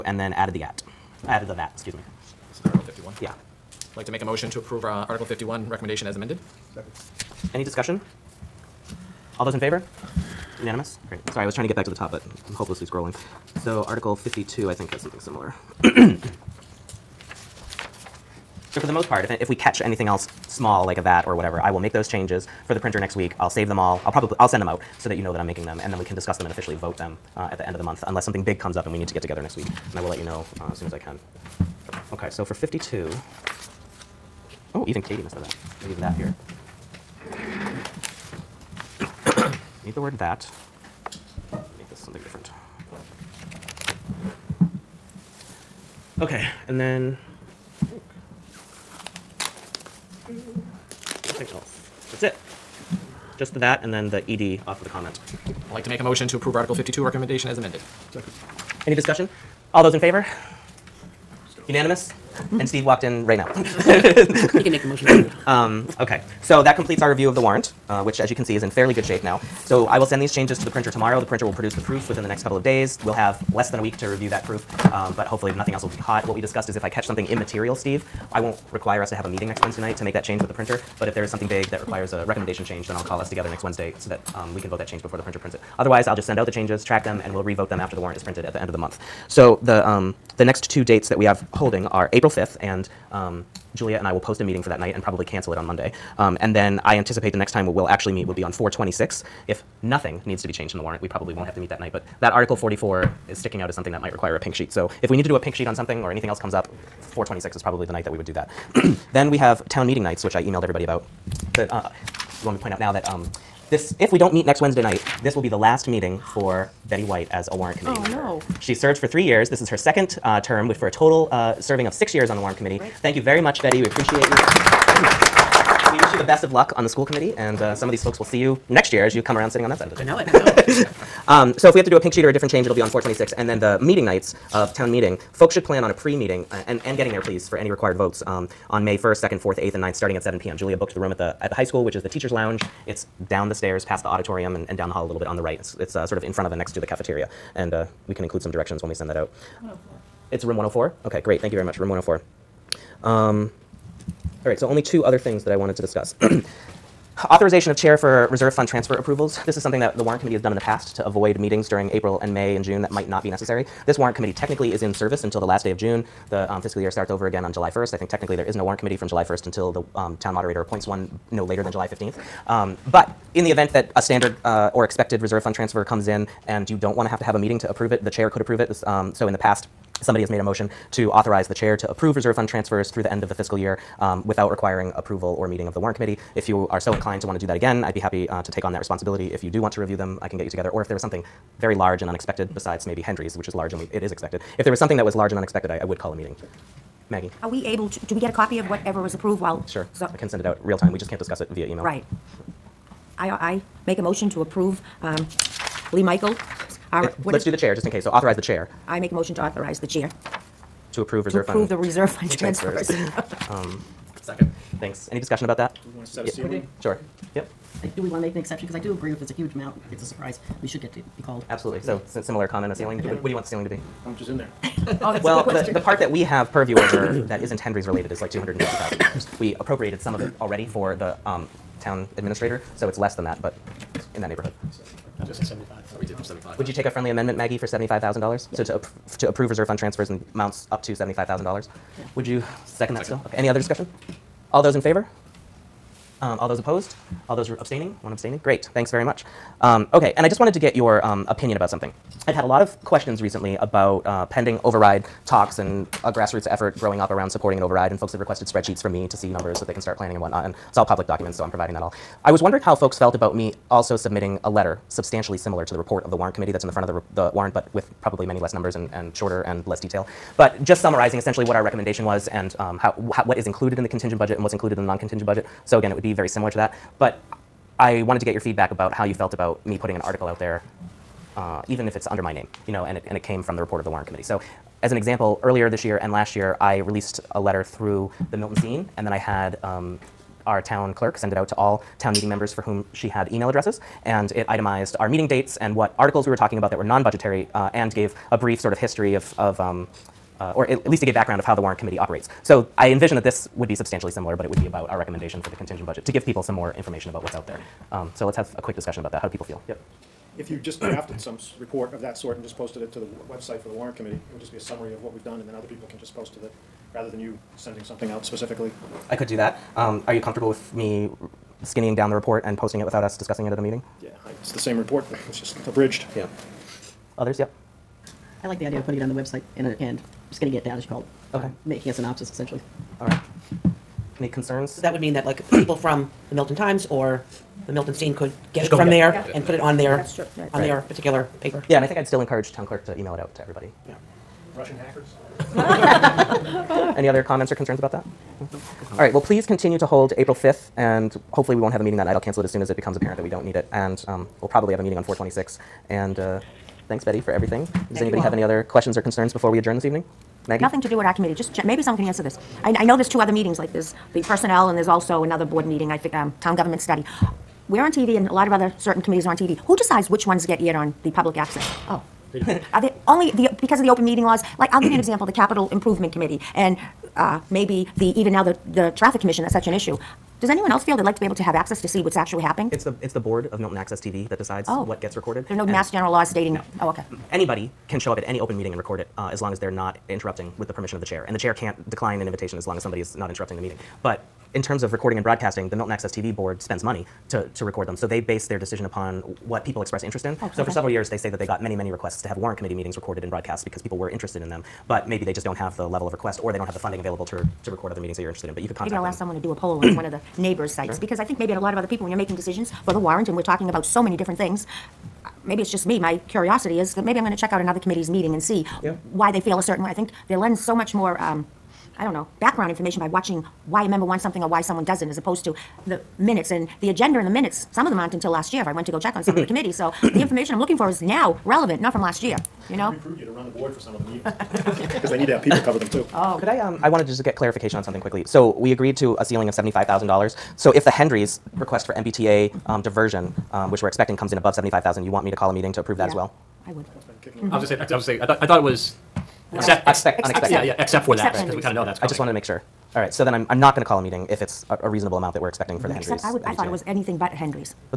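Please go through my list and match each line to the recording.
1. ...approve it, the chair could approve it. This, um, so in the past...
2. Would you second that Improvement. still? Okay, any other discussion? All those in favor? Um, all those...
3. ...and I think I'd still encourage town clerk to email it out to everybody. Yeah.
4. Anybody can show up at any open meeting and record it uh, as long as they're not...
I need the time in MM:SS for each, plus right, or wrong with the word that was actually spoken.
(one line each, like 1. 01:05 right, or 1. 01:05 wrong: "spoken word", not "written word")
1. 02:57 right
2. 04:02 wrong: "Second", not "Improvement"
3. 05:41 right
4. 06:27 right.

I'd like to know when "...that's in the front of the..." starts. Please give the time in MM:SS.
04:26.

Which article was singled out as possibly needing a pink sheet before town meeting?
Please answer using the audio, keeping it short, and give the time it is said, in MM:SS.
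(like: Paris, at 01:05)
Article 44, at 01:42.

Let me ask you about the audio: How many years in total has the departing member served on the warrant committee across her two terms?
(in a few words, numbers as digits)
6.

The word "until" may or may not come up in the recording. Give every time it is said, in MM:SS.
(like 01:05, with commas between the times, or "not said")
02:45, 02:49, 07:08.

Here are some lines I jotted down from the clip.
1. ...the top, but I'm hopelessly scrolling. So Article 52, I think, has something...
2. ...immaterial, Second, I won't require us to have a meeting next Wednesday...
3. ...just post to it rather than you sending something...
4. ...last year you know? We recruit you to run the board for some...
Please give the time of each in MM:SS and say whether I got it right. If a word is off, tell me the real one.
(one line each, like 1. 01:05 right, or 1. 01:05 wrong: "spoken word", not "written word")
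1. 00:11 right
2. 01:17 wrong: "Steve", not "Second"
3. 05:15 right
4. 07:12 right.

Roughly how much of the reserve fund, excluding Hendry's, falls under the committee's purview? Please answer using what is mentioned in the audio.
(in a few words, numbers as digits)
$250,000.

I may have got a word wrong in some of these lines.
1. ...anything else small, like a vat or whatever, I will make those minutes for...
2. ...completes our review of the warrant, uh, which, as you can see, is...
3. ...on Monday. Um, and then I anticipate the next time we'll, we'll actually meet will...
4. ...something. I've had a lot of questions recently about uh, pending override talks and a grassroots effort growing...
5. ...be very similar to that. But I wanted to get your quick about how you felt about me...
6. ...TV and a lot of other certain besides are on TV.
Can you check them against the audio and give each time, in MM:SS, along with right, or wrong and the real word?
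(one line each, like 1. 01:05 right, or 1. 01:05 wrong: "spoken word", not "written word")
1. 00:19 wrong: "changes", not "minutes"
2. 01:06 right
3. 01:35 right
4. 04:11 right
5. 04:36 wrong: "feedback", not "quick"
6. 06:07 wrong: "committees", not "besides".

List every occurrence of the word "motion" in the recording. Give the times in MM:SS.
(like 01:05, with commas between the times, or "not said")
00:04, 00:56, 01:04, 03:00, 03:24, 03:29.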